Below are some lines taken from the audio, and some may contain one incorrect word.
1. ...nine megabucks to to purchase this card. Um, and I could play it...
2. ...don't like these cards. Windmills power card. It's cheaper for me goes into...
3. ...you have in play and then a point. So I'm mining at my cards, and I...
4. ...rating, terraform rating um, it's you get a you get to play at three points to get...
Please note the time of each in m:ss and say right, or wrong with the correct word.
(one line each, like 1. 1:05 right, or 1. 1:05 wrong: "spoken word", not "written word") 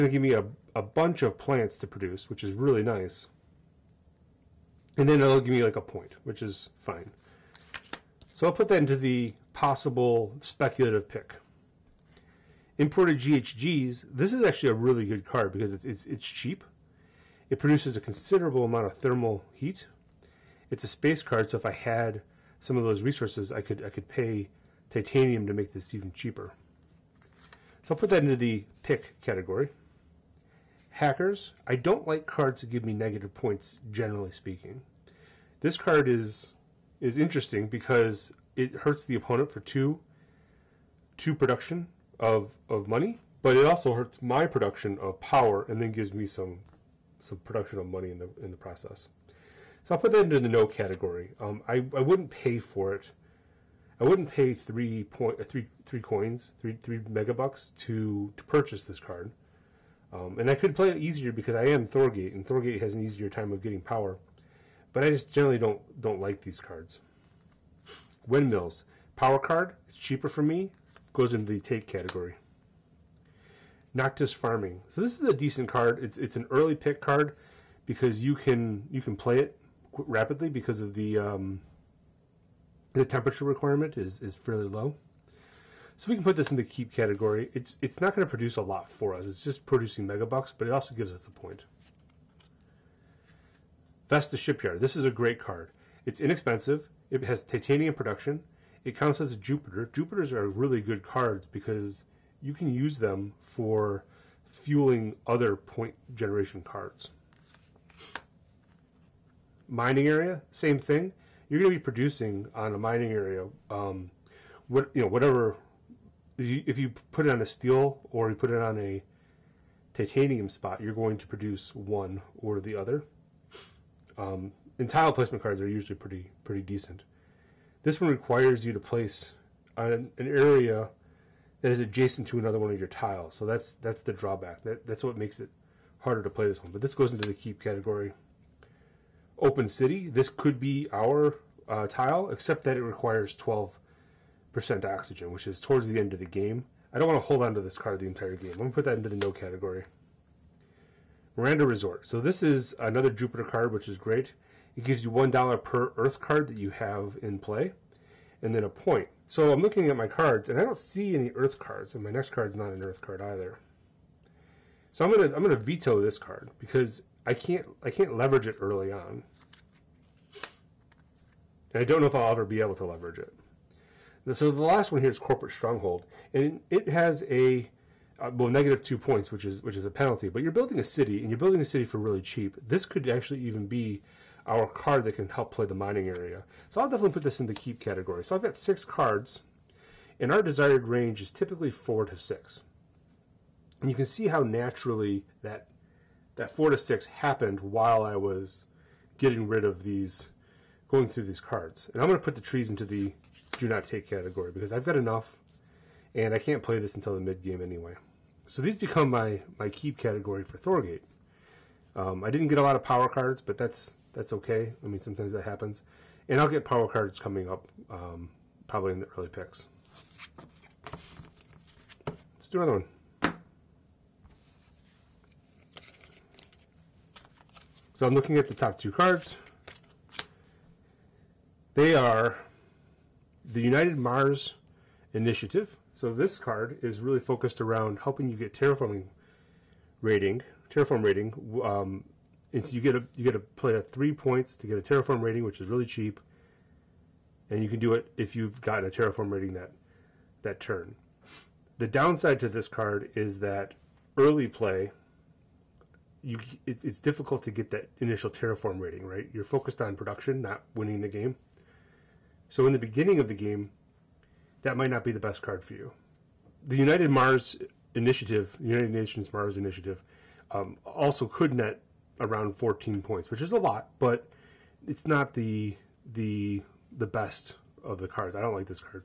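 1. 0:56 wrong: "three", not "nine"
2. 1:05 right
3. 2:36 wrong: "looking", not "mining"
4. 4:00 right.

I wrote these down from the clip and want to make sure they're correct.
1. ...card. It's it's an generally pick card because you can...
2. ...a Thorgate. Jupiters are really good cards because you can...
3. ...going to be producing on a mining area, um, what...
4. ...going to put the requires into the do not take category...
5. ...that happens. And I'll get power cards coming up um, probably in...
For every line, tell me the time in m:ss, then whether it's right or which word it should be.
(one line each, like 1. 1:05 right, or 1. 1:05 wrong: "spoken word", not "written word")
1. 1:15 wrong: "early", not "generally"
2. 1:39 wrong: "Jupiter", not "Thorgate"
3. 1:51 right
4. 3:22 wrong: "trees", not "requires"
5. 3:35 right.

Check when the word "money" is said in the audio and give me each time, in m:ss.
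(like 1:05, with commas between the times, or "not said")
0:42, 0:47.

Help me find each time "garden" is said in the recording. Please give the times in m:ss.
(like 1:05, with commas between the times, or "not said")
not said.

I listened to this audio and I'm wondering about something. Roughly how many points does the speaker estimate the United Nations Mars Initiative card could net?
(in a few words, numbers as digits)
14.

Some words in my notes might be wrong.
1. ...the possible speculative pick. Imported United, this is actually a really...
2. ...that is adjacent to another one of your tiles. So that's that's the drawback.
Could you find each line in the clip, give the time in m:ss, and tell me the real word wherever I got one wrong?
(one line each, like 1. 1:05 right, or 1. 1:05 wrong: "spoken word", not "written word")
1. 0:08 wrong: "GHGs", not "United"
2. 2:11 right.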